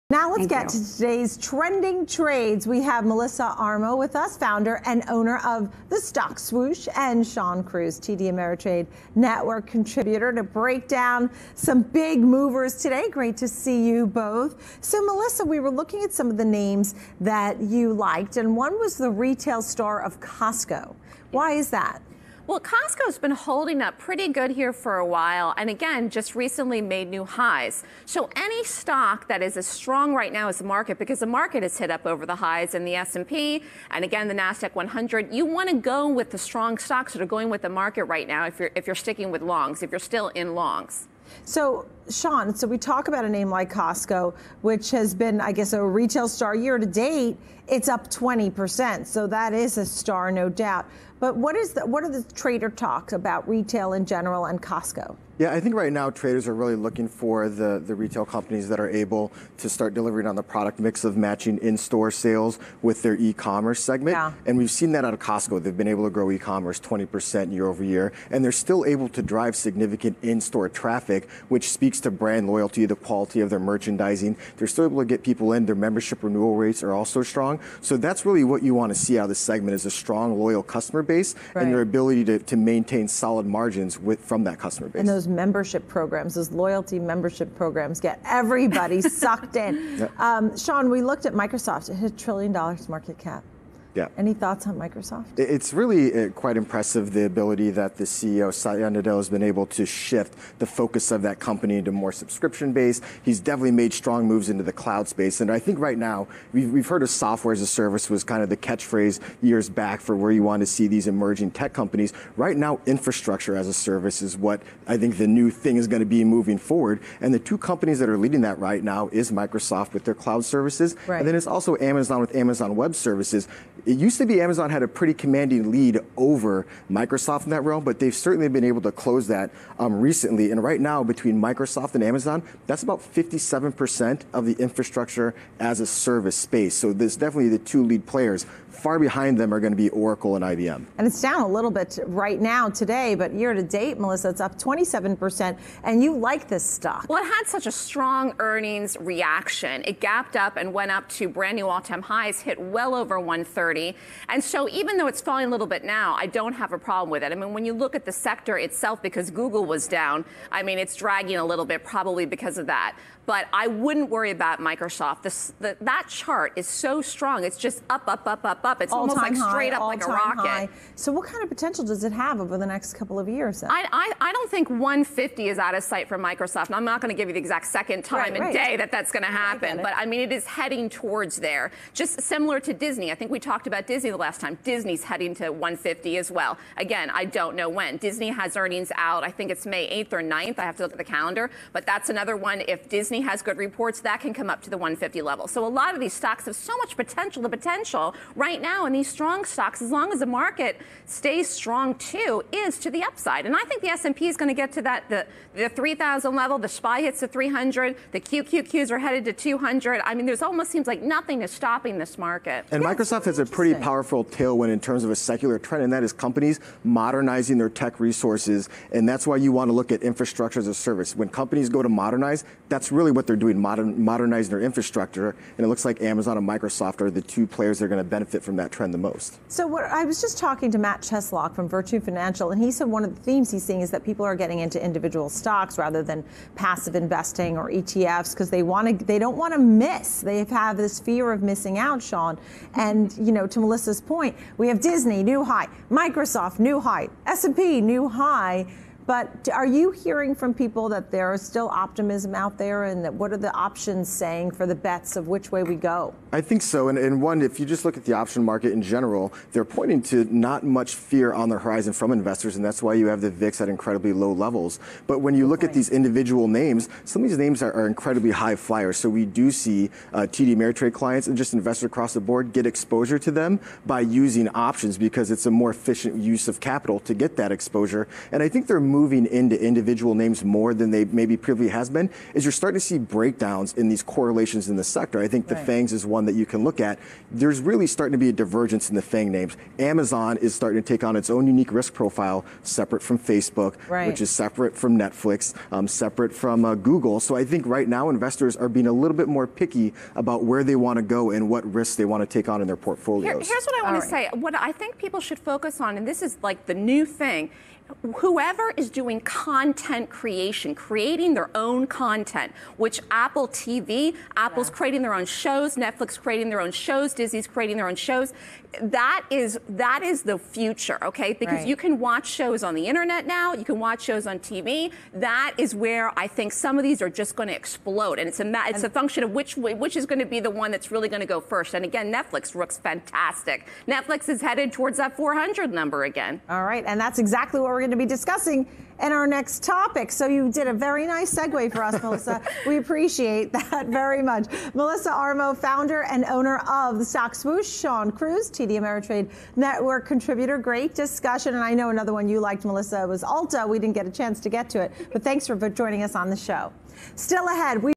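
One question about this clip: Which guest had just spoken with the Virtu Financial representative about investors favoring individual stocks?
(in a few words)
Matt Cheslock.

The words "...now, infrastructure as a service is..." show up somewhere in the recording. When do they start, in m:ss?
1:52.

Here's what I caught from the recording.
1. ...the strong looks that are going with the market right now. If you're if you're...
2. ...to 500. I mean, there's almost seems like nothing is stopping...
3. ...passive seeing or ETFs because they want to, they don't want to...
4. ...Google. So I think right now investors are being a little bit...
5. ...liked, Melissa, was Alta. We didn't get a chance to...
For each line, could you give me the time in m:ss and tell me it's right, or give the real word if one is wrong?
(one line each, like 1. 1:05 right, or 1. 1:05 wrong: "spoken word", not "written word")
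1. 0:36 wrong: "stocks", not "looks"
2. 3:29 wrong: "200", not "500"
3. 3:56 wrong: "investing", not "seeing"
4. 4:56 right
5. 5:52 right.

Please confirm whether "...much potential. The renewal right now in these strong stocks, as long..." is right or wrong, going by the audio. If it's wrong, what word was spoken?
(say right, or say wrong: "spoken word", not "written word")
wrong: "potential", not "renewal".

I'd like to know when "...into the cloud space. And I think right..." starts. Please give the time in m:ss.
1:44.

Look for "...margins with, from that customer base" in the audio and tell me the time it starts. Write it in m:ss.
1:23.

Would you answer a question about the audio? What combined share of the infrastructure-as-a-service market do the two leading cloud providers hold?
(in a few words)
57%.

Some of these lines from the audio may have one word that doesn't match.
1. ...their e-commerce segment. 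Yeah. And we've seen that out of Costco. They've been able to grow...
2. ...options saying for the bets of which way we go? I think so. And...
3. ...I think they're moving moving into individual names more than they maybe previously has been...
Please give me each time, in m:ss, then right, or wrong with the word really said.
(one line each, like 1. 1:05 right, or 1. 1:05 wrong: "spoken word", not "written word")
1. 1:03 right
2. 4:13 right
3. 4:38 right.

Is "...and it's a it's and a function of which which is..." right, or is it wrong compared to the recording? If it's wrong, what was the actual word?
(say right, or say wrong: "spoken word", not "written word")
right.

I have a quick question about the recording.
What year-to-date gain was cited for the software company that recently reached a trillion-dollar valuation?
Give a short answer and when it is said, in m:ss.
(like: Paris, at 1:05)
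27%, at 2:24.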